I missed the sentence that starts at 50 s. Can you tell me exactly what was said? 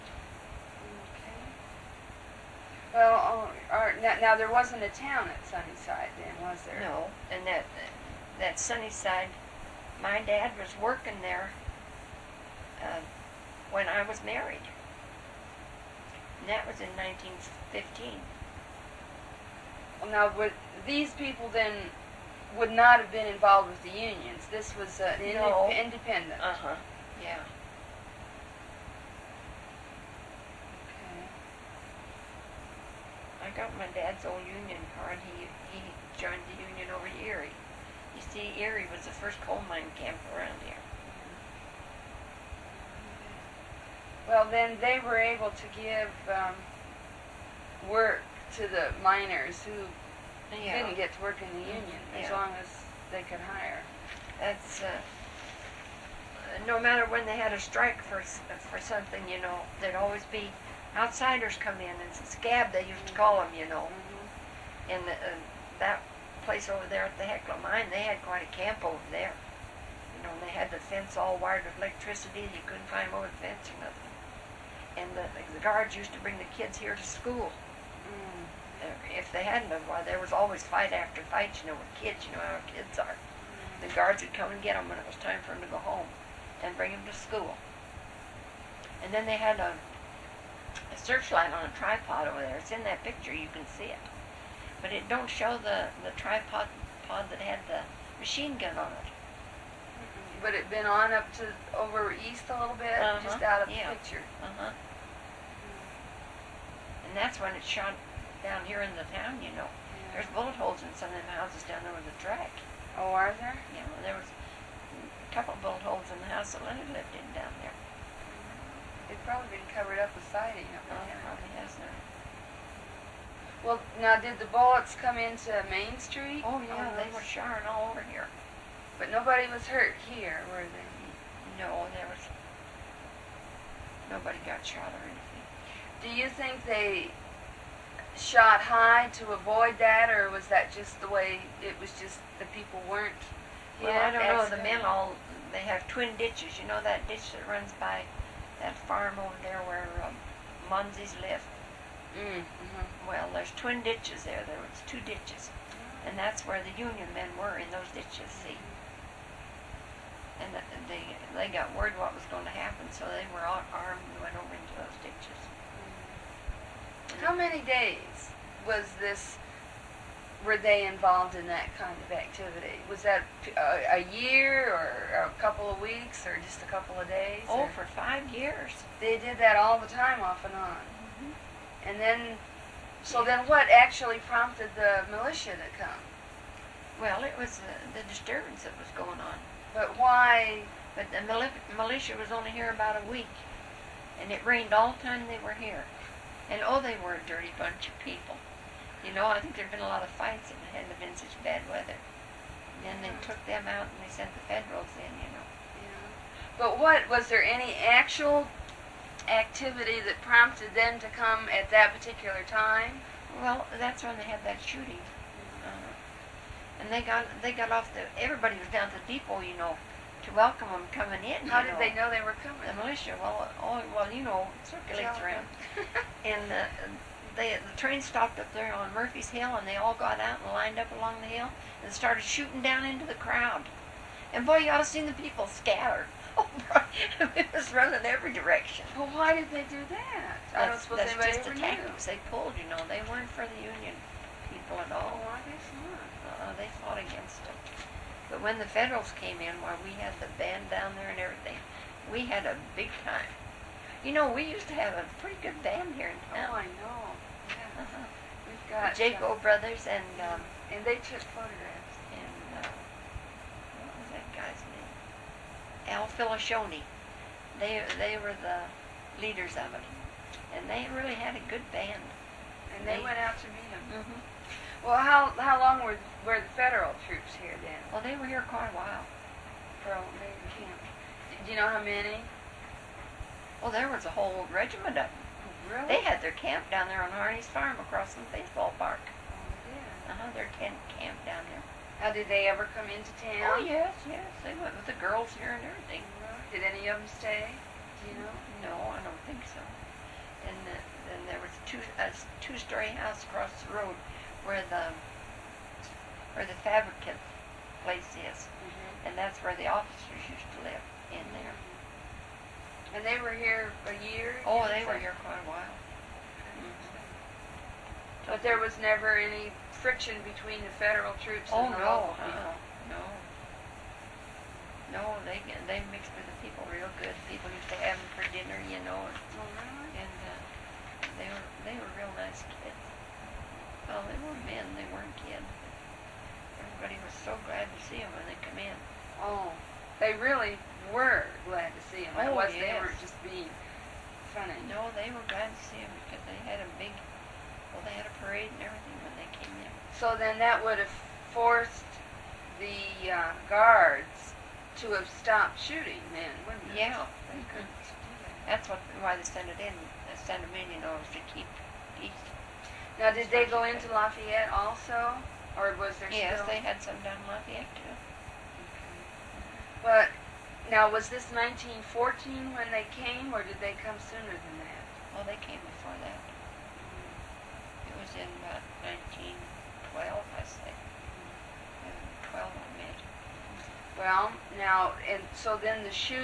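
didn't get to work in the mm, union yeah.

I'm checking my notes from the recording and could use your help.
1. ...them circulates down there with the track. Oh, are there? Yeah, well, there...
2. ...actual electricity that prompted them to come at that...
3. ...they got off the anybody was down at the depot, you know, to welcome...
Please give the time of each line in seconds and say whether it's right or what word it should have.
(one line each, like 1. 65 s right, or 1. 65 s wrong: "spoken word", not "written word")
1. 111 s wrong: "houses", not "circulates"
2. 207 s wrong: "activity", not "electricity"
3. 217 s wrong: "everybody", not "anybody".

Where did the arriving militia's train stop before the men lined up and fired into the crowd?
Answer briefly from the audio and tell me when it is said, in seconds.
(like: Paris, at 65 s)
Murphy's Hill, at 228 s.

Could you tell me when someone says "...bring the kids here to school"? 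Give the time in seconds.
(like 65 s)
76 s.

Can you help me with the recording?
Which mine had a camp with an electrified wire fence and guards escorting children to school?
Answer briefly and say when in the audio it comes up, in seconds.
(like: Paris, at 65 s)
Hecla mine, at 67 s.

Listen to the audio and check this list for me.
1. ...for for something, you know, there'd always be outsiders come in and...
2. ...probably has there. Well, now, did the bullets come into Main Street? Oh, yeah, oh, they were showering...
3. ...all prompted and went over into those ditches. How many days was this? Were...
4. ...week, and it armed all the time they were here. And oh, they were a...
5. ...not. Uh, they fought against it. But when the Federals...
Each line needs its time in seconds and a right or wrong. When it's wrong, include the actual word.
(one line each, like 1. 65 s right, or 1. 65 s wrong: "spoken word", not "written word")
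1. 58 s right
2. 121 s right
3. 163 s wrong: "armed", not "prompted"
4. 193 s wrong: "rained", not "armed"
5. 245 s right.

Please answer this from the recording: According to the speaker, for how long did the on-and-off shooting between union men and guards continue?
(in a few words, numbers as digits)
5 years.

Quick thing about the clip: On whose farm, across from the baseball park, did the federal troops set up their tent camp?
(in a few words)
Harney's Farm.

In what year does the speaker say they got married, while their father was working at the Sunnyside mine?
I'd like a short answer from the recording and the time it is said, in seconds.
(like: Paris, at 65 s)
1915, at 16 s.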